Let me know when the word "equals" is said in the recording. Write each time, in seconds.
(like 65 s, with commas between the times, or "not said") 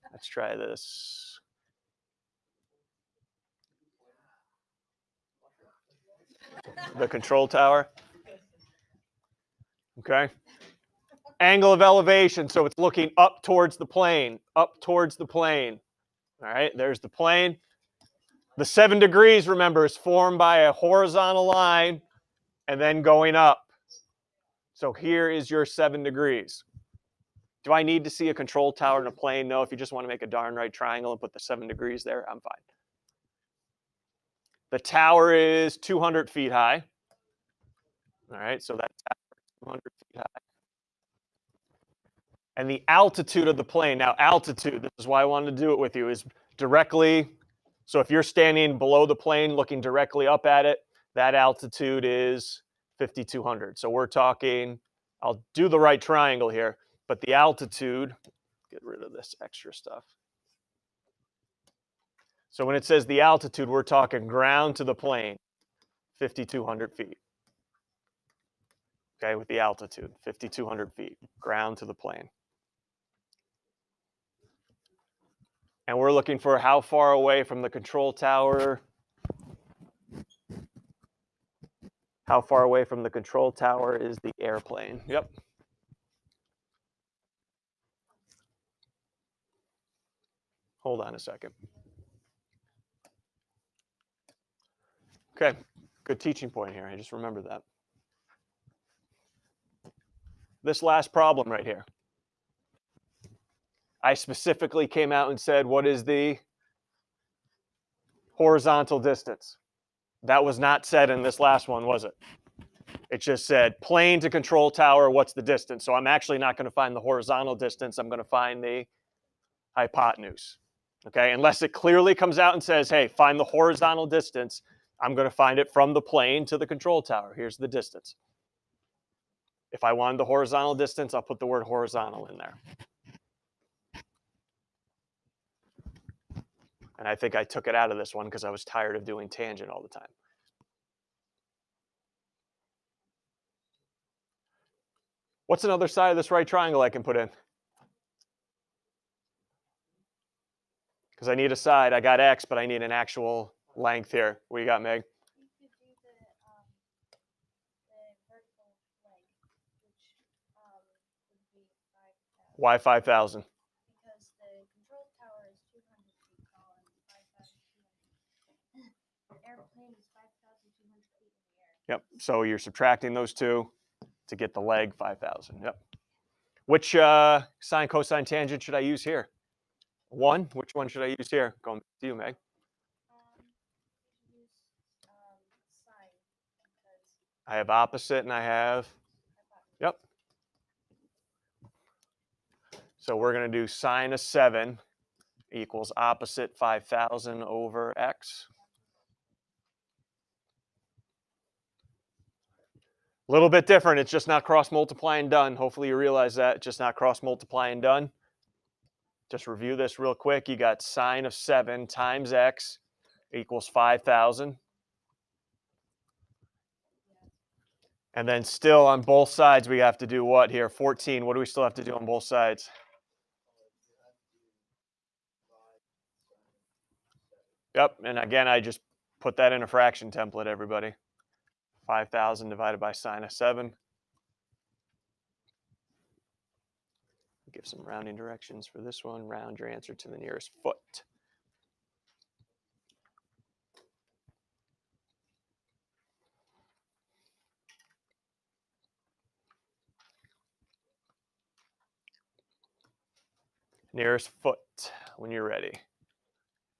195 s, 213 s.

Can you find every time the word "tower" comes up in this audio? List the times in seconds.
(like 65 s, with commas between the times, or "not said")
7 s, 28 s, 34 s, 39 s, 78 s, 83 s, 114 s, 127 s.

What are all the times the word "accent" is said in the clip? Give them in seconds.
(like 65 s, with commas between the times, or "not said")
not said.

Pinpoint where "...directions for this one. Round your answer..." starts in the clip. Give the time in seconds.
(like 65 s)
238 s.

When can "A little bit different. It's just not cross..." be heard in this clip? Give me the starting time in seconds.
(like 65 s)
203 s.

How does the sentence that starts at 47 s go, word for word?
So if you're standing below the plane looking directly up at it, that altitude is 5,200.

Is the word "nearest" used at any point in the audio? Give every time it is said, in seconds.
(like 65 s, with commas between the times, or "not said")
240 s, 253 s.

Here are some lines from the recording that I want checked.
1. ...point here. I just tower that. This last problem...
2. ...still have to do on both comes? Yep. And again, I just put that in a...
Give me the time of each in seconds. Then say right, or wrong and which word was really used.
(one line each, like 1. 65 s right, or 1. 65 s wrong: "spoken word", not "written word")
1. 96 s wrong: "remember", not "tower"
2. 221 s wrong: "sides", not "comes".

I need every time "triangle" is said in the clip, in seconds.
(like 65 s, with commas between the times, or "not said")
30 s, 55 s, 146 s.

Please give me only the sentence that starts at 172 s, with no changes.
So you're subtracting those two to get the leg 5,000.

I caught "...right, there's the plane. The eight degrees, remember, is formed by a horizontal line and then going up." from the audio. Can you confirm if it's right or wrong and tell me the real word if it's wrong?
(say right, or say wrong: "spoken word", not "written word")
wrong: "seven", not "eight".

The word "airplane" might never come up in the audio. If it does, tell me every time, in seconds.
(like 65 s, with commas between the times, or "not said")
84 s.